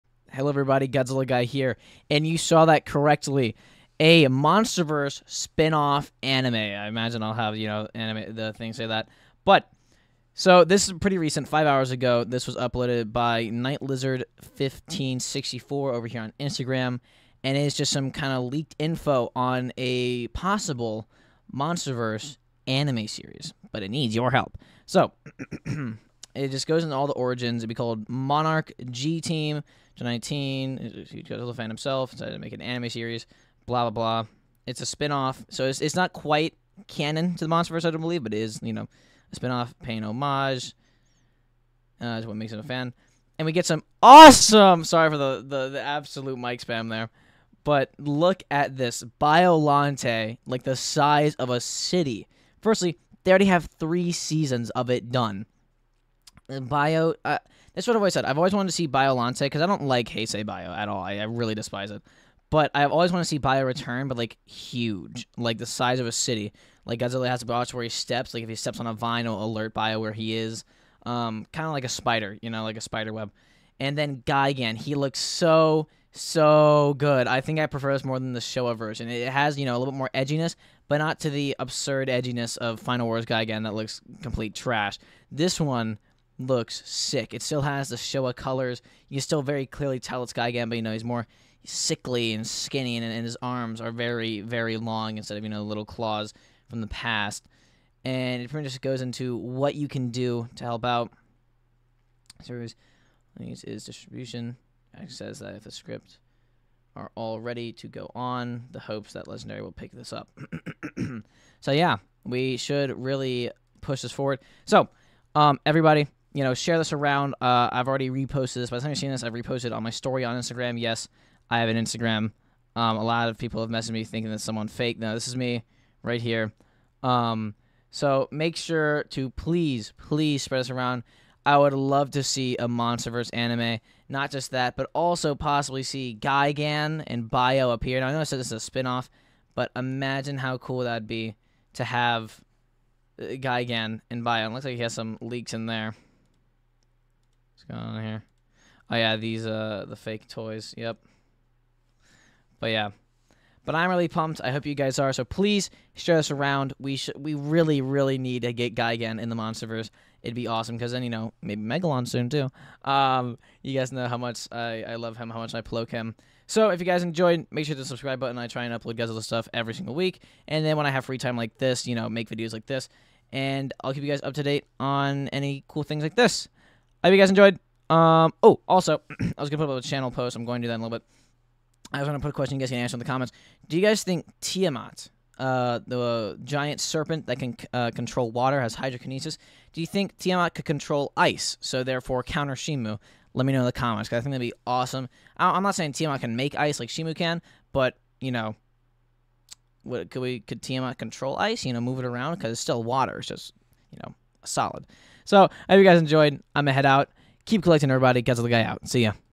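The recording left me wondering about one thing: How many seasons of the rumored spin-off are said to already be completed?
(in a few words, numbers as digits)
3.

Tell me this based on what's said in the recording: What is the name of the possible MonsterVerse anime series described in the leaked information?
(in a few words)
Monarch G Team.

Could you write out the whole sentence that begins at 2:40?
It'd be awesome because then you know maybe Megalon soon too.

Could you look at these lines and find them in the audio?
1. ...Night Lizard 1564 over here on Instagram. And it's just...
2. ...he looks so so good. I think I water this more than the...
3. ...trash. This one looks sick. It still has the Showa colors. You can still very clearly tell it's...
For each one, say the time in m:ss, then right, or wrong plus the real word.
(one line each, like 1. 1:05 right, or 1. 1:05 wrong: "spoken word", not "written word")
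1. 0:13 right
2. 1:14 wrong: "prefer", not "water"
3. 1:24 right.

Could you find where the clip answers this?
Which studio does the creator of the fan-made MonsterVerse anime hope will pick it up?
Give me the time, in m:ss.
1:49.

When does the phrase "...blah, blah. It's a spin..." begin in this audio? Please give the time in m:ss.
0:33.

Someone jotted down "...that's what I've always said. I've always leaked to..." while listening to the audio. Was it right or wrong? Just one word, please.
wrong.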